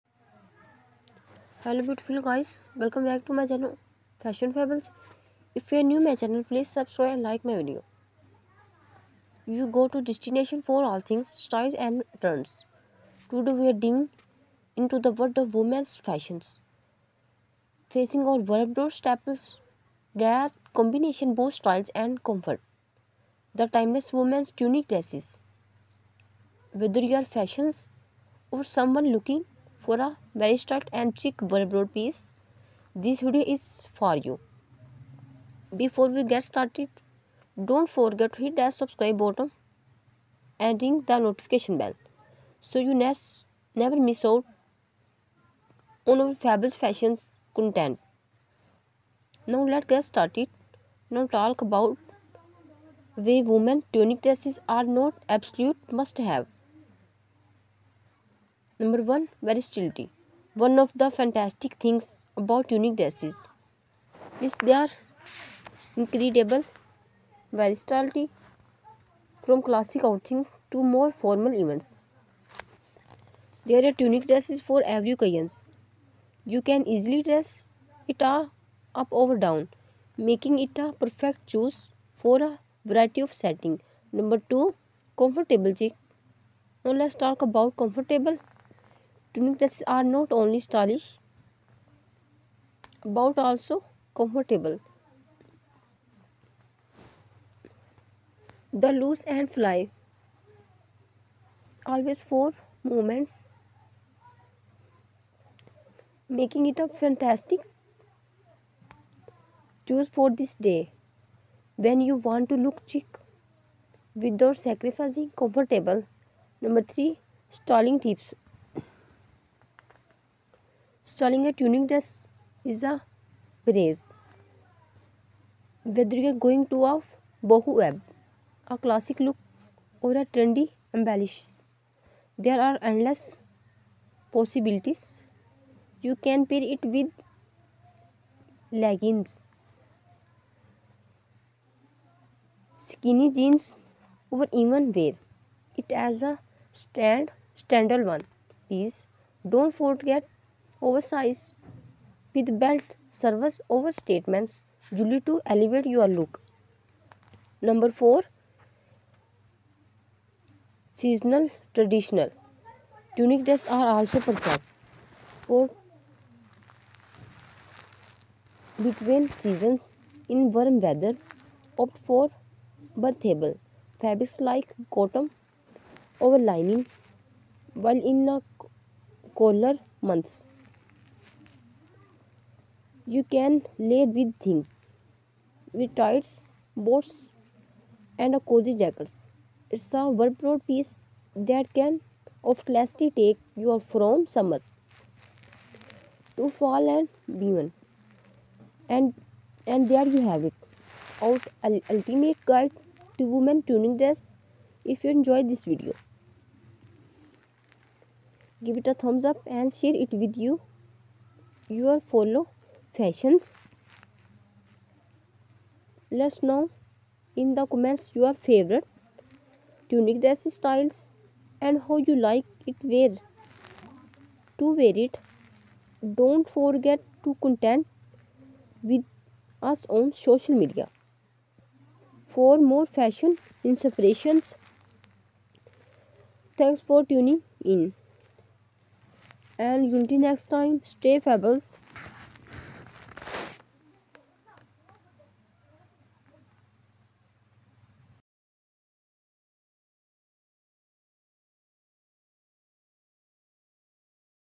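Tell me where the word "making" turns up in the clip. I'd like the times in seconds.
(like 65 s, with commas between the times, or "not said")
80 s, 106 s.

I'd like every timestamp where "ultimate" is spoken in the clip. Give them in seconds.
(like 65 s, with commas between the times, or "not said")
201 s.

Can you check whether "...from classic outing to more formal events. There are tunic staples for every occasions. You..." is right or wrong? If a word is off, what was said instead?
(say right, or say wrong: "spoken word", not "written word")
wrong: "dresses", not "staples".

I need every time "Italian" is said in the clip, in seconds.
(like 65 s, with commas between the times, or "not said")
not said.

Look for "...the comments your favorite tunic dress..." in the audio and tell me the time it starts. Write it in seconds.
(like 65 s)
217 s.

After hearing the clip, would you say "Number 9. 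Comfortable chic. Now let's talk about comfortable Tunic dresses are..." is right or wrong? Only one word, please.
wrong.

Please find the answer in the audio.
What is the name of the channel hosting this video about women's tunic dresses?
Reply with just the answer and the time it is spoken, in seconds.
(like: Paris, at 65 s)
Fashion Fabulous, at 4 s.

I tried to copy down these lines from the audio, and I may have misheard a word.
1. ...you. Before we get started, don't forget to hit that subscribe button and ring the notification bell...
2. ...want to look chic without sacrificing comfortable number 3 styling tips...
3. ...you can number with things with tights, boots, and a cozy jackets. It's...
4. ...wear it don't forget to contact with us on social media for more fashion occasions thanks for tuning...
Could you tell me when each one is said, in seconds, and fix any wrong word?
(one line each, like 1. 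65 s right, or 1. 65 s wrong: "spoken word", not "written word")
1. 34 s right
2. 112 s right
3. 183 s wrong: "layer", not "number"
4. 224 s wrong: "inspirations", not "occasions".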